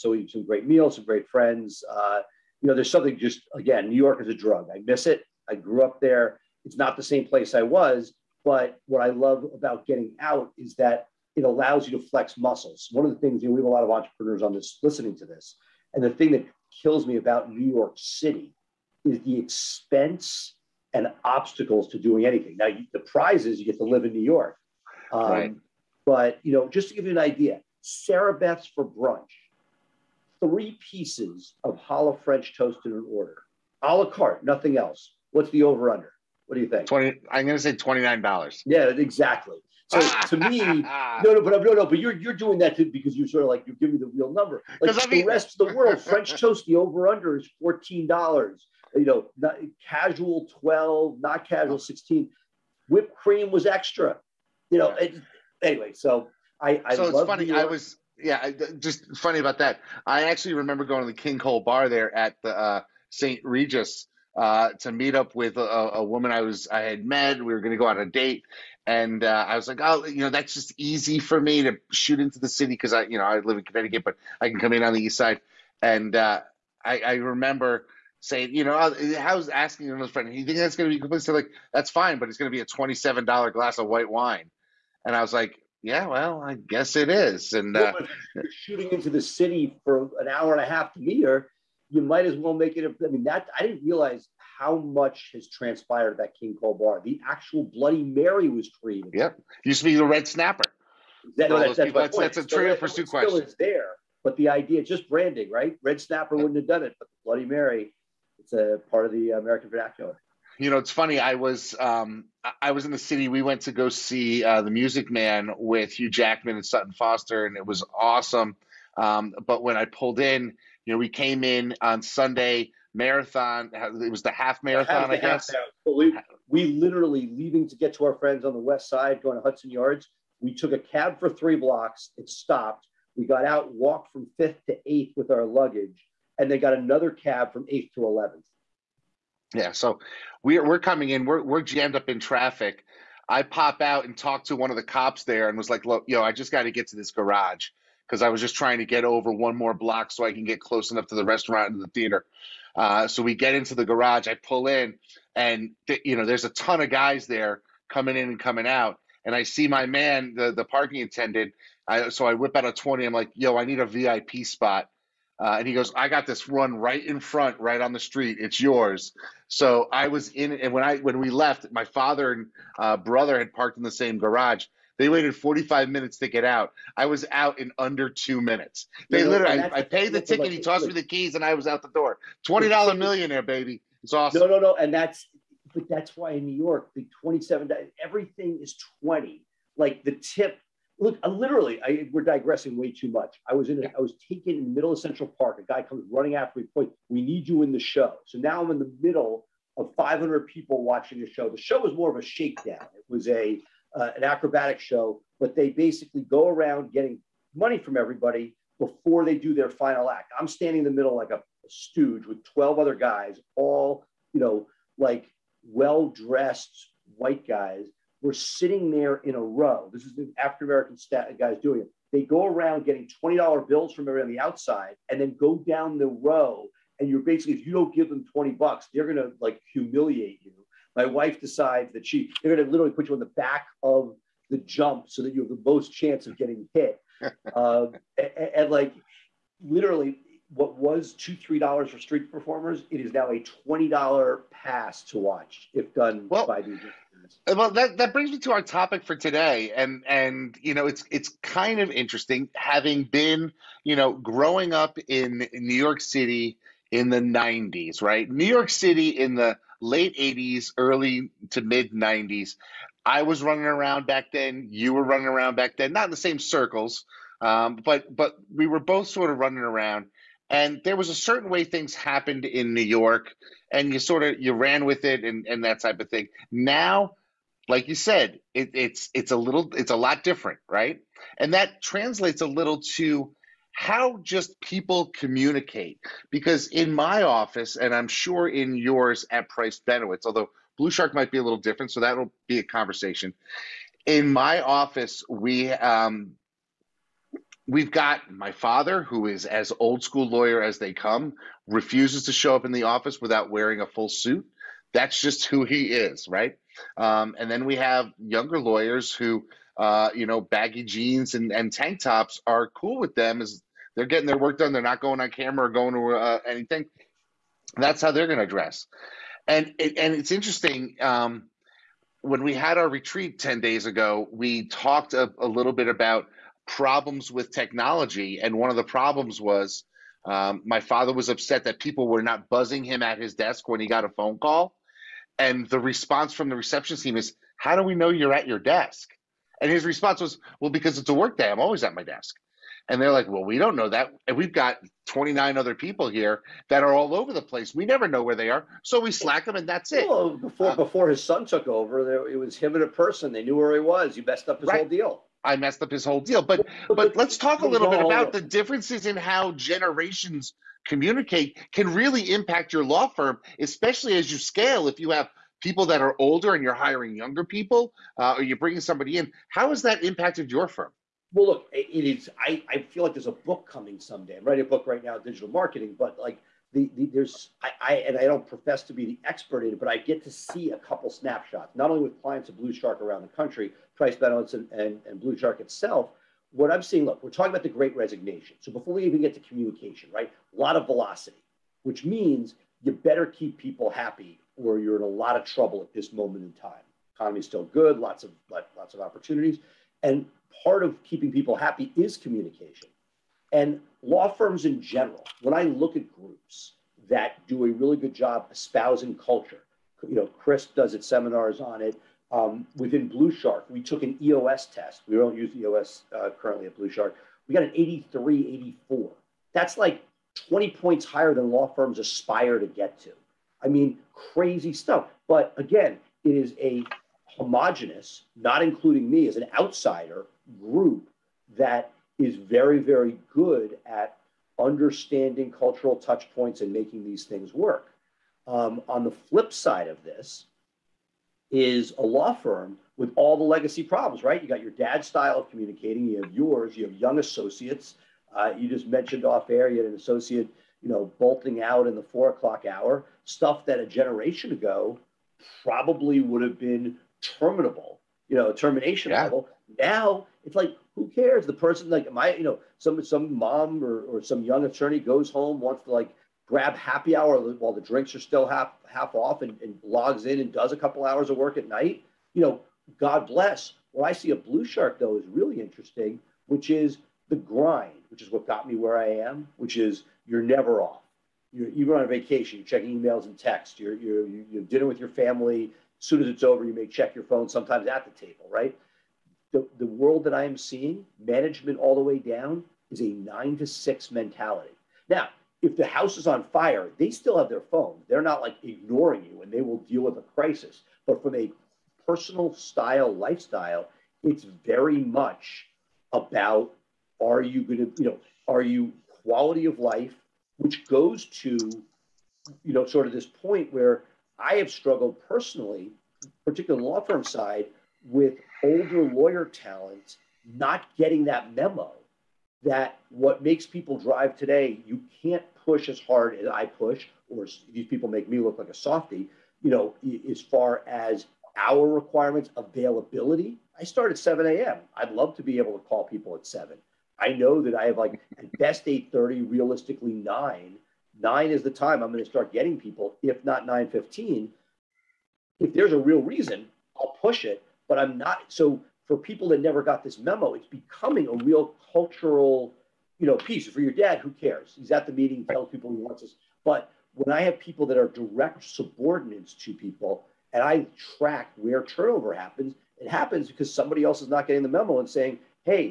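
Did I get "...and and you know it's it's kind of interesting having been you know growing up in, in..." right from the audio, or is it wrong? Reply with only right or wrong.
right.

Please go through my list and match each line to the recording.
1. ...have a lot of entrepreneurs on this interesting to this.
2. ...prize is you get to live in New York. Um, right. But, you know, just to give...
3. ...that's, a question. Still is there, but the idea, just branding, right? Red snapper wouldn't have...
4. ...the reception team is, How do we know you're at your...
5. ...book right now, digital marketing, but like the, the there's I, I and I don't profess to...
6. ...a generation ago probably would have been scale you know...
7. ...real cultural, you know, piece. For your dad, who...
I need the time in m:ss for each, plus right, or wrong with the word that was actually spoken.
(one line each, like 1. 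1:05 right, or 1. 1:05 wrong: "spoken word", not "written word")
1. 0:13 wrong: "listening", not "interesting"
2. 0:22 right
3. 1:42 right
4. 5:36 right
5. 6:14 right
6. 7:33 wrong: "terminable", not "scale"
7. 9:11 right.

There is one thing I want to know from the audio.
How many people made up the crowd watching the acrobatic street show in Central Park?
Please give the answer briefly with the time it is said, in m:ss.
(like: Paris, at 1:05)
500, at 3:19.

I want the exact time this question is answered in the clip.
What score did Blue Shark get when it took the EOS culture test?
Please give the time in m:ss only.
6:57.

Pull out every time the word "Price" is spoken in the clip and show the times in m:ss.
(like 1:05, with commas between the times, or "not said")
4:49, 6:23.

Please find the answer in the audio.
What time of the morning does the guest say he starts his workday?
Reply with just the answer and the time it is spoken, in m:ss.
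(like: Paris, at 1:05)
7 a.m., at 8:54.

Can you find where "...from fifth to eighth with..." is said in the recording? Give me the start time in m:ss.
2:14.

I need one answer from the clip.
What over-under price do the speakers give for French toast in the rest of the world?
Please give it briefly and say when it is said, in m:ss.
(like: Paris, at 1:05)
$14, at 0:47.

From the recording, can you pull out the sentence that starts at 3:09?
Like the tip, look, I uh, literally, I, we're digressing way too much.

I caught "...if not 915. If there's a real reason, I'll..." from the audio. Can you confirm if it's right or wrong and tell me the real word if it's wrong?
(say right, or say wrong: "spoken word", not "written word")
right.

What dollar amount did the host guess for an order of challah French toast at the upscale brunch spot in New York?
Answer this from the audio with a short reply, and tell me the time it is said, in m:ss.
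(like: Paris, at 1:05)
$29, at 0:37.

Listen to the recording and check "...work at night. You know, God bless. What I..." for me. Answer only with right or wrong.
right.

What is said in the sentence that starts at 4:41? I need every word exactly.
And that translates a little to how just people communicate.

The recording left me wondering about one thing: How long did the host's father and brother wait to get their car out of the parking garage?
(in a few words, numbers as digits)
45 minutes.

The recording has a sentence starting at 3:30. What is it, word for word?
I'm standing in the middle like a, a stooge with 12 other guys, all, you know, like well dressed white guys.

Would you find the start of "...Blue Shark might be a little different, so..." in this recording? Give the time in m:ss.
4:50.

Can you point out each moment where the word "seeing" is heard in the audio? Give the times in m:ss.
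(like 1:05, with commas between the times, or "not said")
6:26, 8:10.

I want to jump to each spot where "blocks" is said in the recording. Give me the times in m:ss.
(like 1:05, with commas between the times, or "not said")
2:11, 2:29.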